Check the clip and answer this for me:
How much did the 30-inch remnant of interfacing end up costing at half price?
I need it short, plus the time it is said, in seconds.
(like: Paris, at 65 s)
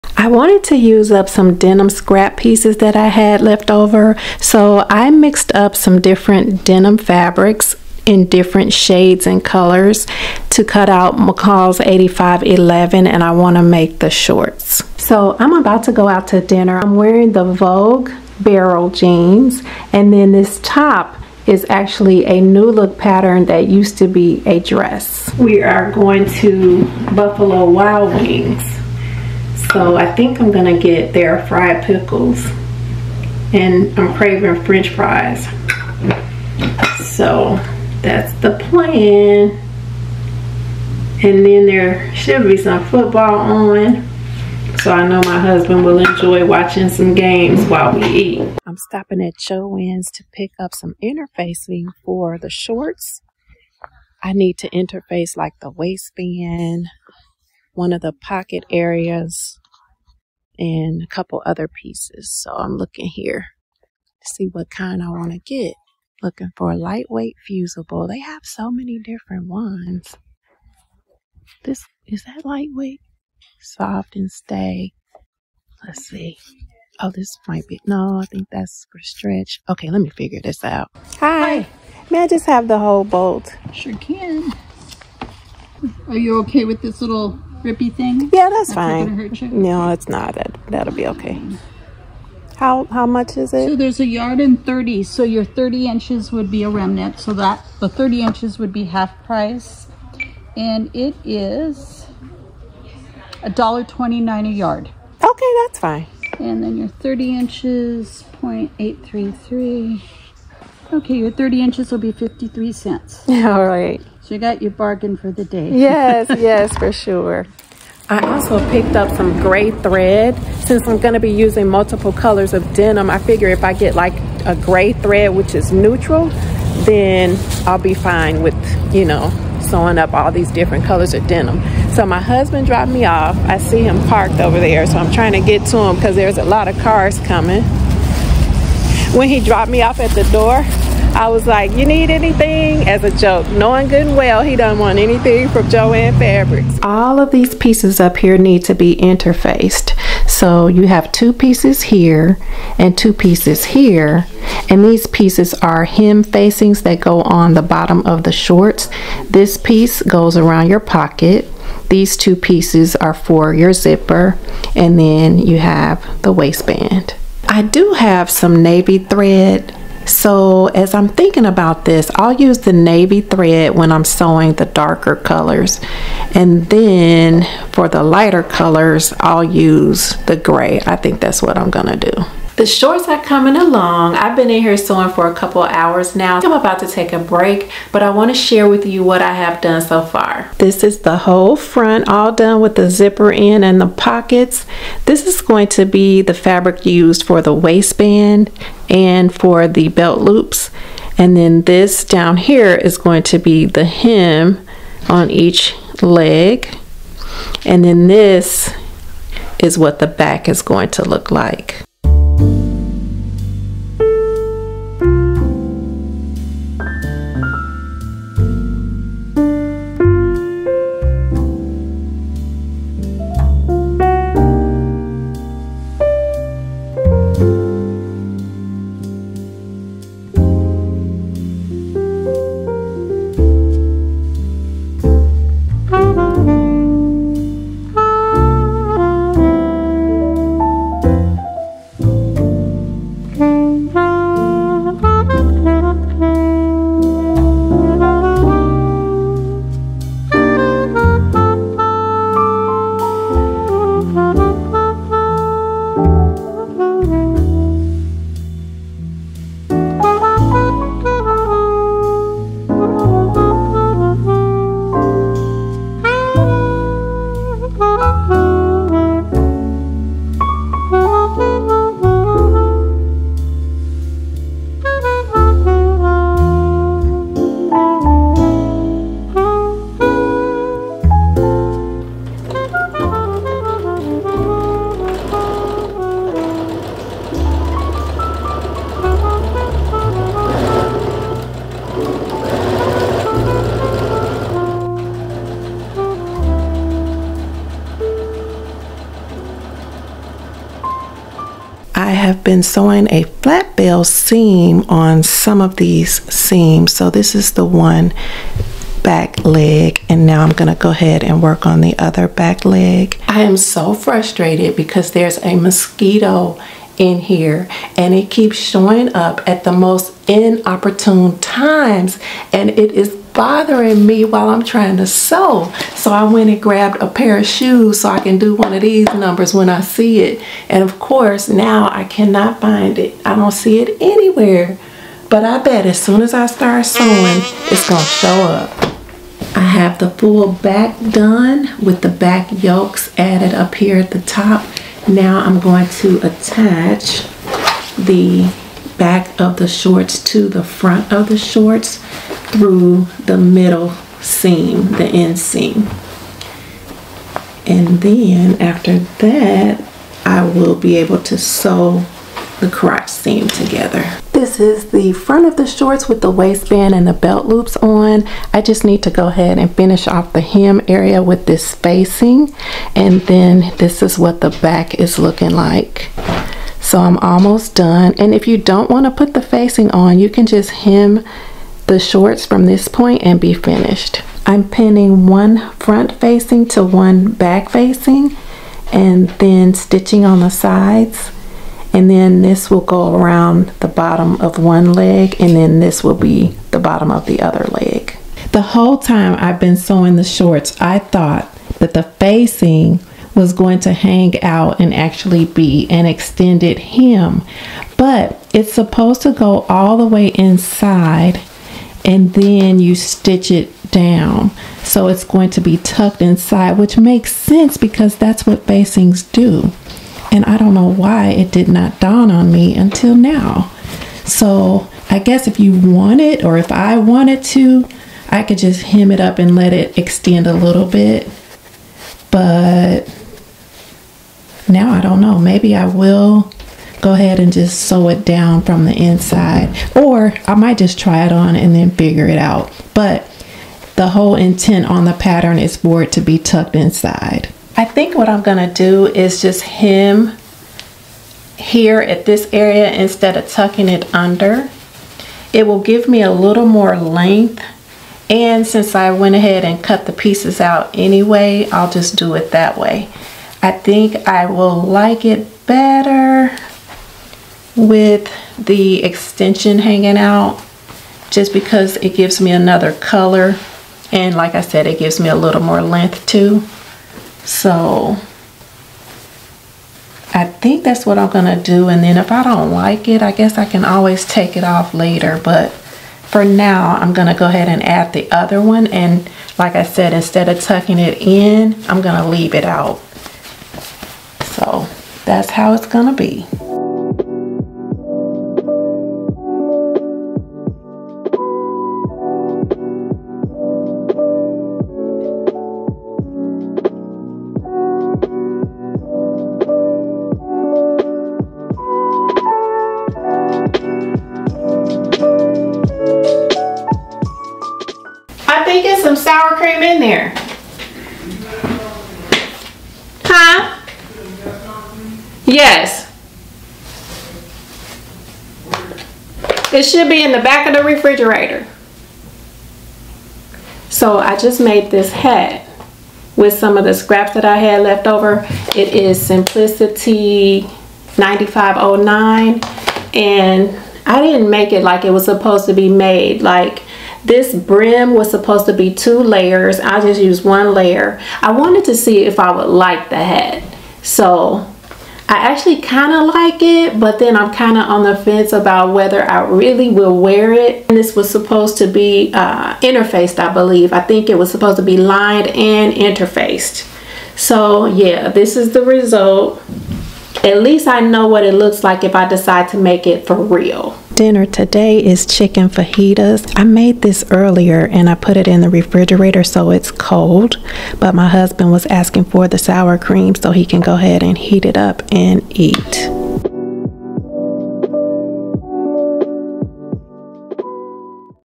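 53 cents, at 112 s.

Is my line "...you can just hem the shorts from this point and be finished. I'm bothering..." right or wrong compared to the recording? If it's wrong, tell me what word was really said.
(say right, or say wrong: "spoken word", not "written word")
wrong: "pinning", not "bothering".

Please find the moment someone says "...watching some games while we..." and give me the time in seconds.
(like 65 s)
46 s.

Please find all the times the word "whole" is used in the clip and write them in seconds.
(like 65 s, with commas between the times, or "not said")
82 s, 191 s, 398 s, 444 s.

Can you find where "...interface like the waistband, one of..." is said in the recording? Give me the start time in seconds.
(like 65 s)
54 s.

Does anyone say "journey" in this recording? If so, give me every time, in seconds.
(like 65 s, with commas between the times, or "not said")
not said.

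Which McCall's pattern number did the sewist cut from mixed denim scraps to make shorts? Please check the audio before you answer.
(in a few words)
8511.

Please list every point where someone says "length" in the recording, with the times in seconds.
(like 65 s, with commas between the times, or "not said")
456 s, 475 s.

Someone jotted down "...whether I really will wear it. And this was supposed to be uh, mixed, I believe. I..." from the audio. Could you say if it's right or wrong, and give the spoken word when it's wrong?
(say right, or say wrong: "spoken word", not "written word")
wrong: "interfaced", not "mixed".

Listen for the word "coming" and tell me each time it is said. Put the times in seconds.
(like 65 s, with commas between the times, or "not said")
137 s, 183 s.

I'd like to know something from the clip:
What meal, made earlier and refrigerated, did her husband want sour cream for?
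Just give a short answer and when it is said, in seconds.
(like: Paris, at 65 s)
chicken fajitas, at 575 s.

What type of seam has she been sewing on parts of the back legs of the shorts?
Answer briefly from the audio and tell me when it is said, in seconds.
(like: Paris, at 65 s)
flat fell seam, at 303 s.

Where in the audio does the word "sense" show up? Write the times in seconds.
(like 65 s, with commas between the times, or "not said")
417 s.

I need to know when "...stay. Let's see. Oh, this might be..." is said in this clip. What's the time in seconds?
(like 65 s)
74 s.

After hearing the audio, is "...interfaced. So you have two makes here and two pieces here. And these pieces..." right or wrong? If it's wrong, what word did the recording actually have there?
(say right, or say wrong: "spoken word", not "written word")
wrong: "pieces", not "makes".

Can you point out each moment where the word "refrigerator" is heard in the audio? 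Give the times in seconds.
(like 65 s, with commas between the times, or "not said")
530 s, 578 s.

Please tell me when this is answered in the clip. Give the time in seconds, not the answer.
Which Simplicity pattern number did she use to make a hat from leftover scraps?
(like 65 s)
539 s.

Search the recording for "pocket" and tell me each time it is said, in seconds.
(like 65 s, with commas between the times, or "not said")
58 s, 160 s, 193 s.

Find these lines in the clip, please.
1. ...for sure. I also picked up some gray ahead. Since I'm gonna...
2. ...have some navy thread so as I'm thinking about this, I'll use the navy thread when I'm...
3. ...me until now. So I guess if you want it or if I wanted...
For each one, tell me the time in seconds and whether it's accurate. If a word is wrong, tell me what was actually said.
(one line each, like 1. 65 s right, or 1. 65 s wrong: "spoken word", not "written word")
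1. 116 s wrong: "thread", not "ahead"
2. 167 s right
3. 422 s right.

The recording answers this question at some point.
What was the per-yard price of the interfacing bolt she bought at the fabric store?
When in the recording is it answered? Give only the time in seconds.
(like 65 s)
103 s.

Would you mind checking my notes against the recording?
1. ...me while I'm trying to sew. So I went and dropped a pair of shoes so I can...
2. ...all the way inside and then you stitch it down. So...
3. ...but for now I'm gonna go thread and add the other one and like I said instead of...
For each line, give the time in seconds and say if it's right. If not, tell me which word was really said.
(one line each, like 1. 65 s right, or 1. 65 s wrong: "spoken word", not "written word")
1. 324 s wrong: "grabbed", not "dropped"
2. 409 s right
3. 485 s wrong: "ahead", not "thread".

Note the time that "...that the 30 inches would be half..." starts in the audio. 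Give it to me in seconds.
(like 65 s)
97 s.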